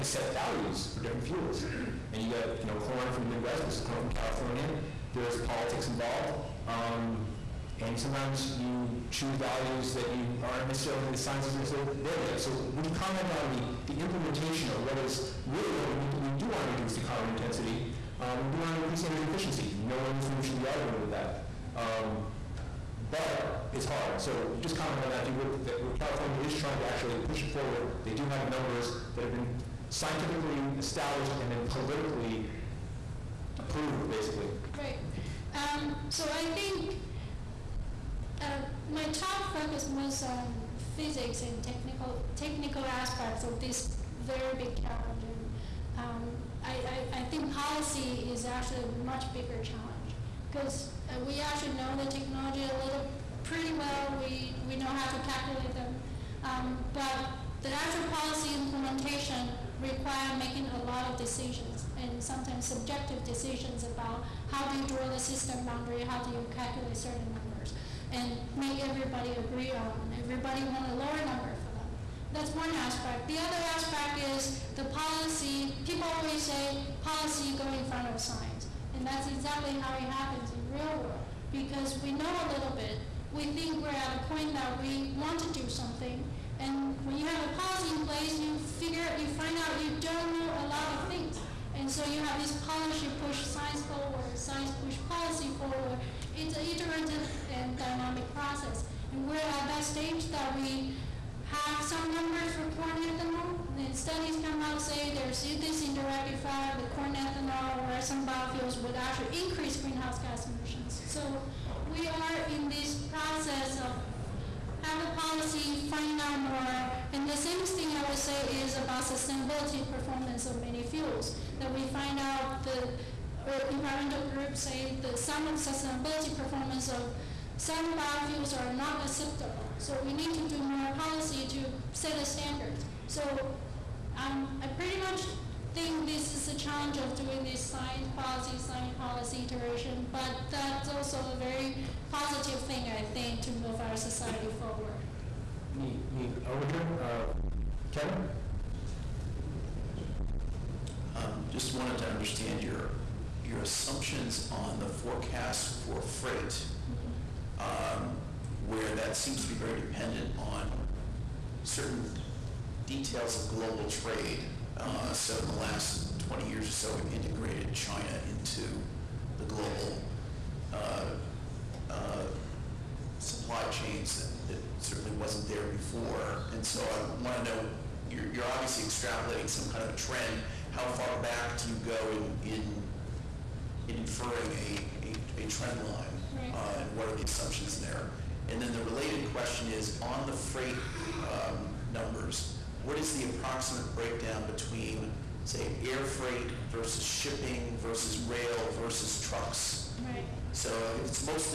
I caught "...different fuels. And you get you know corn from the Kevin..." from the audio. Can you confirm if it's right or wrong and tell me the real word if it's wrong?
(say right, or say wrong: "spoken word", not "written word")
wrong: "Midwest", not "Kevin".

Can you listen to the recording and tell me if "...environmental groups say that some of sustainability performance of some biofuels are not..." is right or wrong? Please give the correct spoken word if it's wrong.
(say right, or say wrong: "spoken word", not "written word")
right.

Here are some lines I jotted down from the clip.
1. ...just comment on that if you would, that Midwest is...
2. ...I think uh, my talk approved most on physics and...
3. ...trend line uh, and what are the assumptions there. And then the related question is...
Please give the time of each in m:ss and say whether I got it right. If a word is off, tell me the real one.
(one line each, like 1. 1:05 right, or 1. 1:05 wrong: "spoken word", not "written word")
1. 0:24 wrong: "California", not "Midwest"
2. 0:36 wrong: "focused", not "approved"
3. 3:05 right.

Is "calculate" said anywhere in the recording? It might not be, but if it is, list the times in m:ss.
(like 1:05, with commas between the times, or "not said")
0:55, 1:06.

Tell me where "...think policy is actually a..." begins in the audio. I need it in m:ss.
0:47.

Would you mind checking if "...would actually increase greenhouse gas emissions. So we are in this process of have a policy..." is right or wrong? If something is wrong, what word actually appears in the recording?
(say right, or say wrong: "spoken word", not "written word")
right.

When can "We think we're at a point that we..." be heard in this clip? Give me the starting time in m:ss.
1:23.